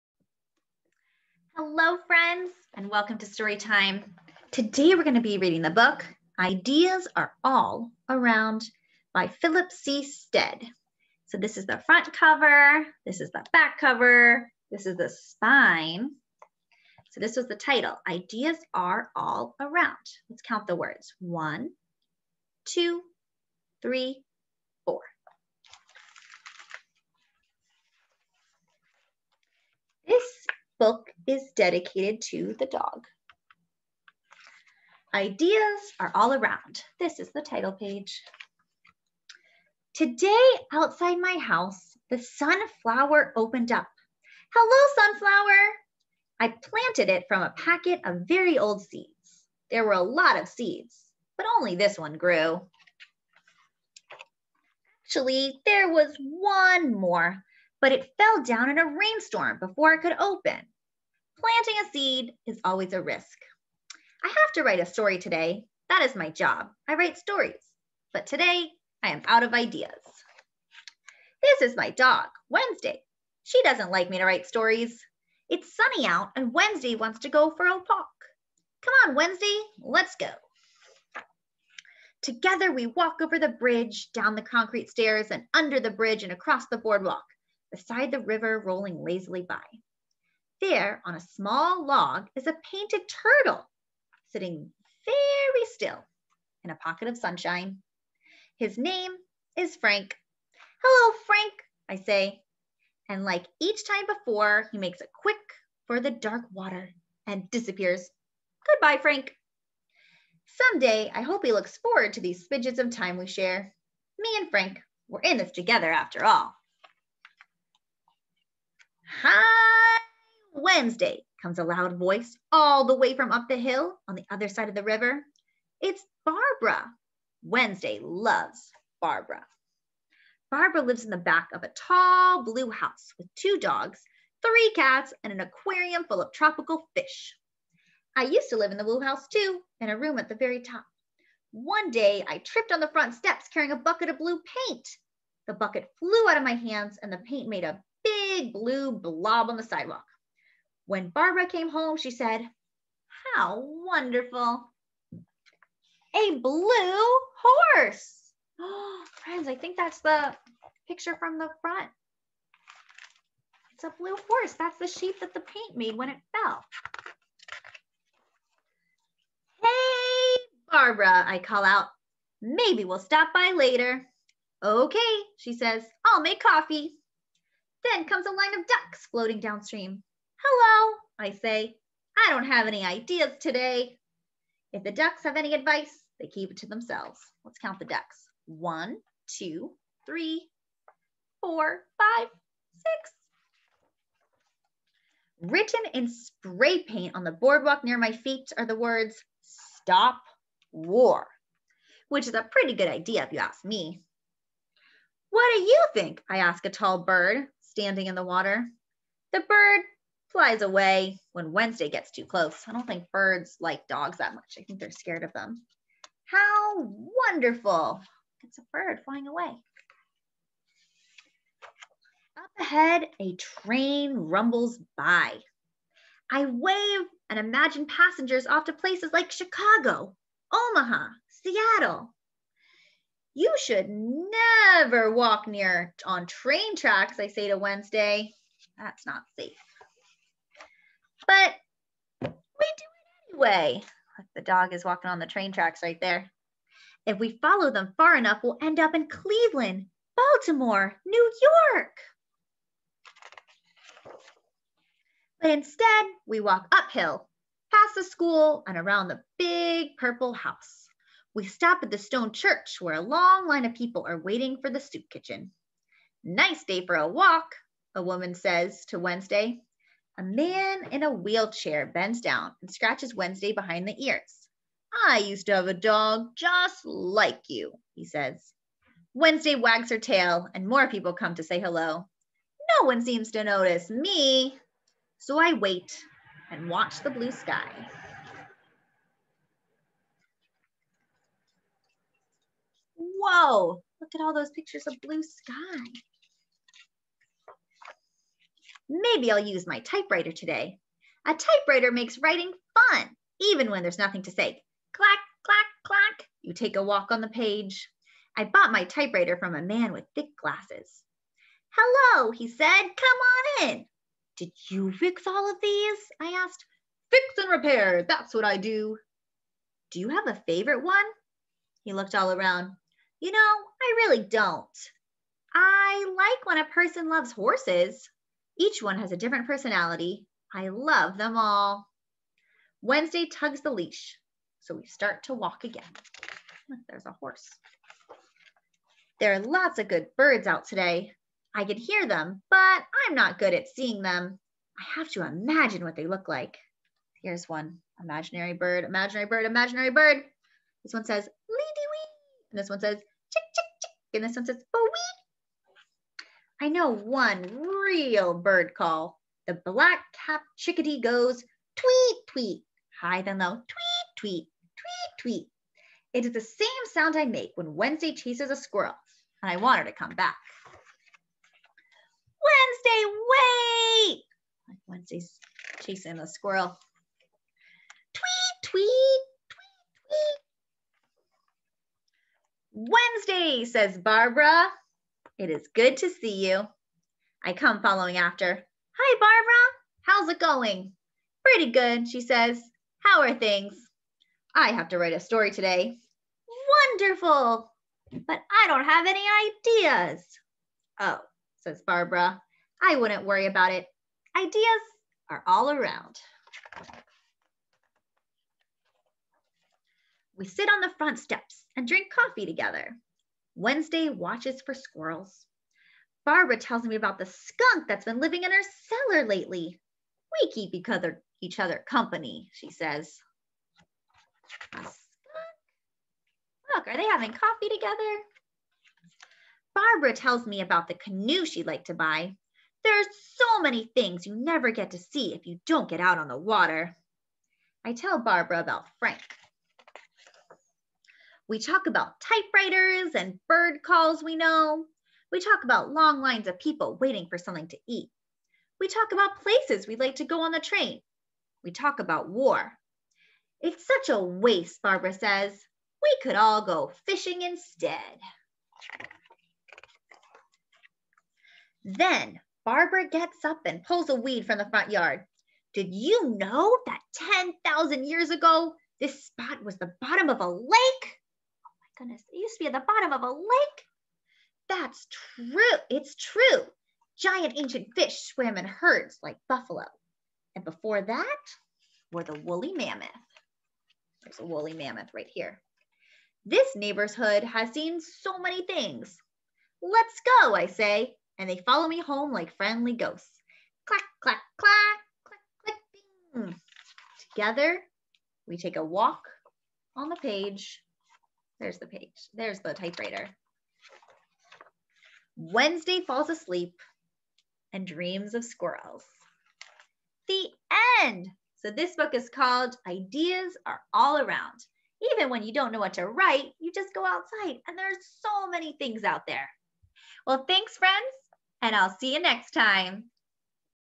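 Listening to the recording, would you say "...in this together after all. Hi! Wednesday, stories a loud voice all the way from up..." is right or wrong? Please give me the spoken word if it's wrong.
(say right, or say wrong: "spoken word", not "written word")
wrong: "comes", not "stories".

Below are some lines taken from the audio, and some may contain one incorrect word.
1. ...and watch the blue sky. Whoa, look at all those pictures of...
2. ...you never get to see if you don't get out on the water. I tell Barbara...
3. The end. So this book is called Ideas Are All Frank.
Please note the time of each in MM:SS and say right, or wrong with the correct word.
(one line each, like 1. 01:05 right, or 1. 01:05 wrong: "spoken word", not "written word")
1. 04:46 right
2. 07:14 right
3. 08:30 wrong: "Around", not "Frank".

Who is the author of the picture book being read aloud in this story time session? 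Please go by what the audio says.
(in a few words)
Philip C. Stead.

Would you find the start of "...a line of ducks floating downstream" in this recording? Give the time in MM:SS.
02:58.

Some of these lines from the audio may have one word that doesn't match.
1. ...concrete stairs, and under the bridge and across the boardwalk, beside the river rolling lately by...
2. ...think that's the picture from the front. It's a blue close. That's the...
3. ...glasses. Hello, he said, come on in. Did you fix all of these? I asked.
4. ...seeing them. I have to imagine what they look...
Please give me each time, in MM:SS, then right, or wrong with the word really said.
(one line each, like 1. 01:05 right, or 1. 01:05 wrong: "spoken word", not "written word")
1. 01:24 wrong: "lazily", not "lately"
2. 02:39 wrong: "horse", not "close"
3. 05:10 right
4. 05:43 right.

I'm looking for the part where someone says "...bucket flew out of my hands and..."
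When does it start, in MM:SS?
02:25.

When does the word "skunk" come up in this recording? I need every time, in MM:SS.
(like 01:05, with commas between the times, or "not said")
06:57, 07:04.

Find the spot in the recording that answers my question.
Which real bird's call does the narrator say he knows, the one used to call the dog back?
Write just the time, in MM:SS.
05:59.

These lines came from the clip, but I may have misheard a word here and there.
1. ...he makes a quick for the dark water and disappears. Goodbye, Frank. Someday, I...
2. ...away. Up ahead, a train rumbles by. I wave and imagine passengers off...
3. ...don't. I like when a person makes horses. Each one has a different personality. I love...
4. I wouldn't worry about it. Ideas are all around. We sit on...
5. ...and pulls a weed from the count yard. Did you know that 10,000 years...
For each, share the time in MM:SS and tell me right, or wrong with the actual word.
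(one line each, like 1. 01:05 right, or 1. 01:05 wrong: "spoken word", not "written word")
1. 01:44 right
2. 03:39 right
3. 05:24 wrong: "loves", not "makes"
4. 06:42 right
5. 07:43 wrong: "front", not "count".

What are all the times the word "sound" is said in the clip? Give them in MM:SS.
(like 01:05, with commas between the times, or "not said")
06:06.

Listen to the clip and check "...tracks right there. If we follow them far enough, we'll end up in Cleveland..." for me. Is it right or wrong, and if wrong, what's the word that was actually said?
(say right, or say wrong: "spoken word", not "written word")
right.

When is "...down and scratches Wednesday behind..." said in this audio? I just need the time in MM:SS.
04:32.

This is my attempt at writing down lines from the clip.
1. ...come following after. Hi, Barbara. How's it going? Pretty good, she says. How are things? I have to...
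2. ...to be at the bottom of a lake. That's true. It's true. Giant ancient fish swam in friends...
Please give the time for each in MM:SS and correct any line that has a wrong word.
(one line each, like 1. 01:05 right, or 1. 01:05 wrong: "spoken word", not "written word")
1. 06:27 right
2. 07:52 wrong: "herds", not "friends".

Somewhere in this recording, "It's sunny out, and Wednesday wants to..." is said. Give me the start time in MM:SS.
01:15.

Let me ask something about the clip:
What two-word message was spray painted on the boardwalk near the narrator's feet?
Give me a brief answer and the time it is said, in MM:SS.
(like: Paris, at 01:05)
Stop war, at 03:19.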